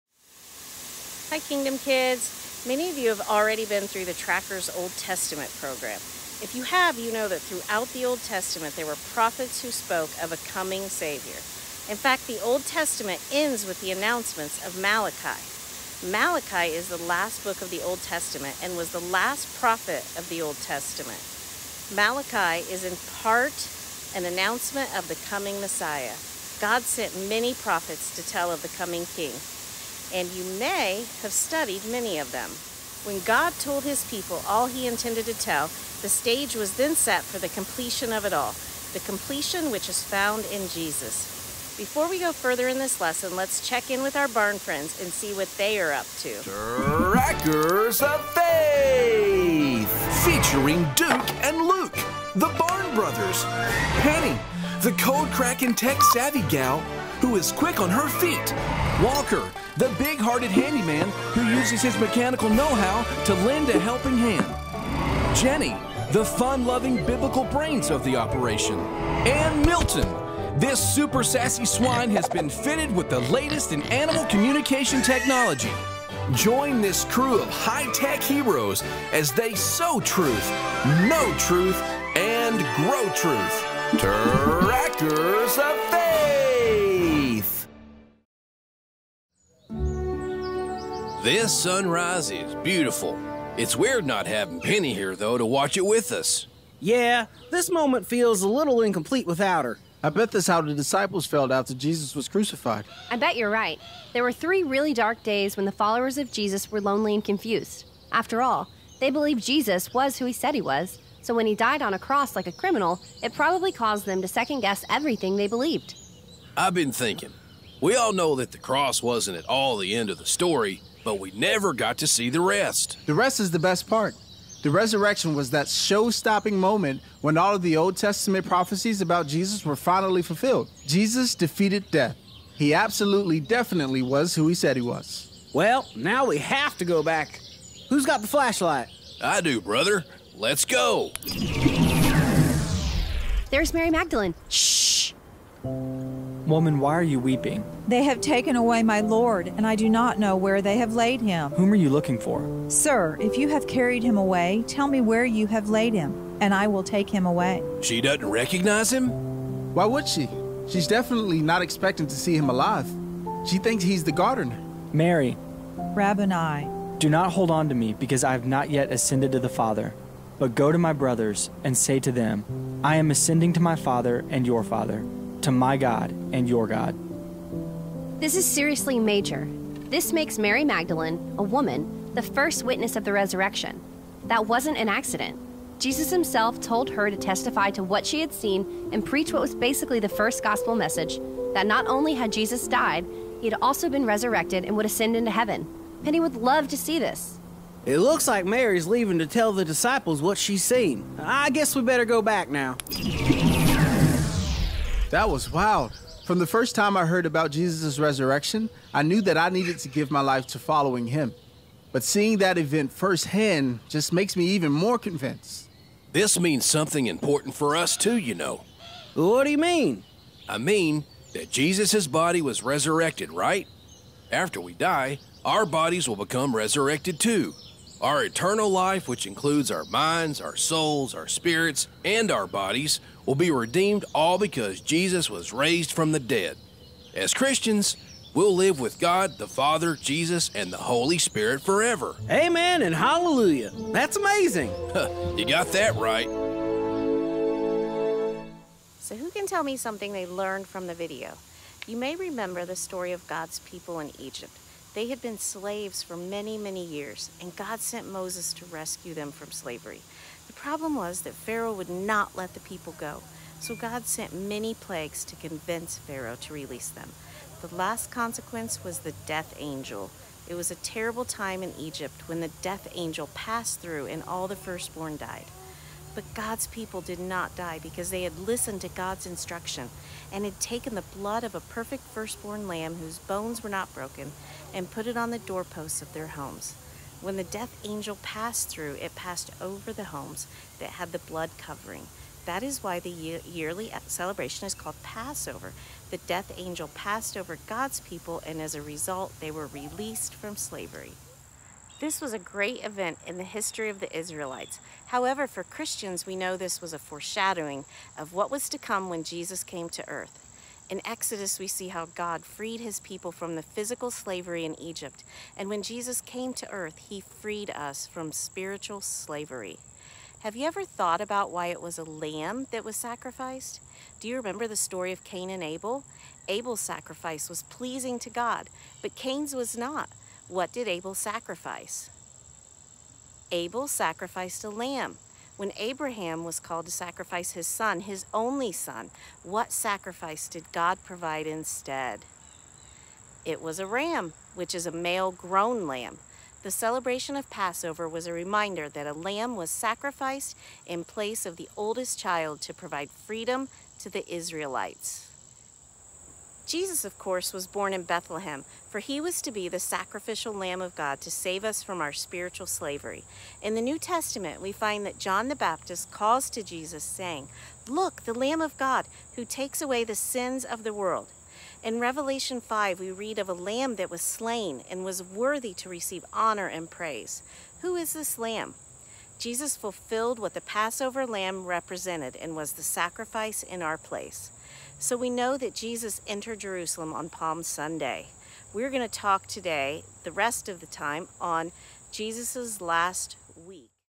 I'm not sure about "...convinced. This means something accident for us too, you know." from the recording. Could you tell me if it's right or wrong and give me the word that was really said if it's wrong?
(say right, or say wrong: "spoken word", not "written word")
wrong: "important", not "accident".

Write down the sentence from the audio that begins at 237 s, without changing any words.
As Christians, we'll live with God, the Father, Jesus, and the Holy Spirit forever.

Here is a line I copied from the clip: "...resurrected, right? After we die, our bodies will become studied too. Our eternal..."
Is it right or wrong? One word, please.
wrong.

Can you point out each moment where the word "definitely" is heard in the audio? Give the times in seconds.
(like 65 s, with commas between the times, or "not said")
133 s, 160 s.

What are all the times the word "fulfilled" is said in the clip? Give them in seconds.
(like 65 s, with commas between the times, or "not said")
130 s, 379 s.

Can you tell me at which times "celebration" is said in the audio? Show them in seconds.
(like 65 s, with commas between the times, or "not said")
294 s, 346 s.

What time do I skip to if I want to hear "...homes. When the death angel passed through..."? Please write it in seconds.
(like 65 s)
286 s.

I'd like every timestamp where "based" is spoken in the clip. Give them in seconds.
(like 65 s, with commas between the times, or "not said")
not said.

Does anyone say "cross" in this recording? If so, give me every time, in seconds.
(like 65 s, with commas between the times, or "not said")
111 s, 118 s.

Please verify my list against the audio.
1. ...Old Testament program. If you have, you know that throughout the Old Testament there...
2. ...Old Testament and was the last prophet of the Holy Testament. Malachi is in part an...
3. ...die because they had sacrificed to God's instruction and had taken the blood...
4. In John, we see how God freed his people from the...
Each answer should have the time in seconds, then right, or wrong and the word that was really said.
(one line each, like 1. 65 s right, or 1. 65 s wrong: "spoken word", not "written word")
1. 4 s right
2. 17 s wrong: "Old", not "Holy"
3. 277 s wrong: "listened", not "sacrificed"
4. 310 s wrong: "Exodus", not "John".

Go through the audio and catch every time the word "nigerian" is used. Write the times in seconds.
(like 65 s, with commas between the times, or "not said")
not said.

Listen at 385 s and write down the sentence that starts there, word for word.
So we know that Jesus entered Jerusalem on Palm Sunday.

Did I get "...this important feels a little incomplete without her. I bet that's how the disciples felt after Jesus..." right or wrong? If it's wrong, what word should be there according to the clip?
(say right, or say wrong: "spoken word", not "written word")
wrong: "moment", not "important".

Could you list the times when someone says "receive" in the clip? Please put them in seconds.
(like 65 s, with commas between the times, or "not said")
375 s.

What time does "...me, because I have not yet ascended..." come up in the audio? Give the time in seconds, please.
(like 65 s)
167 s.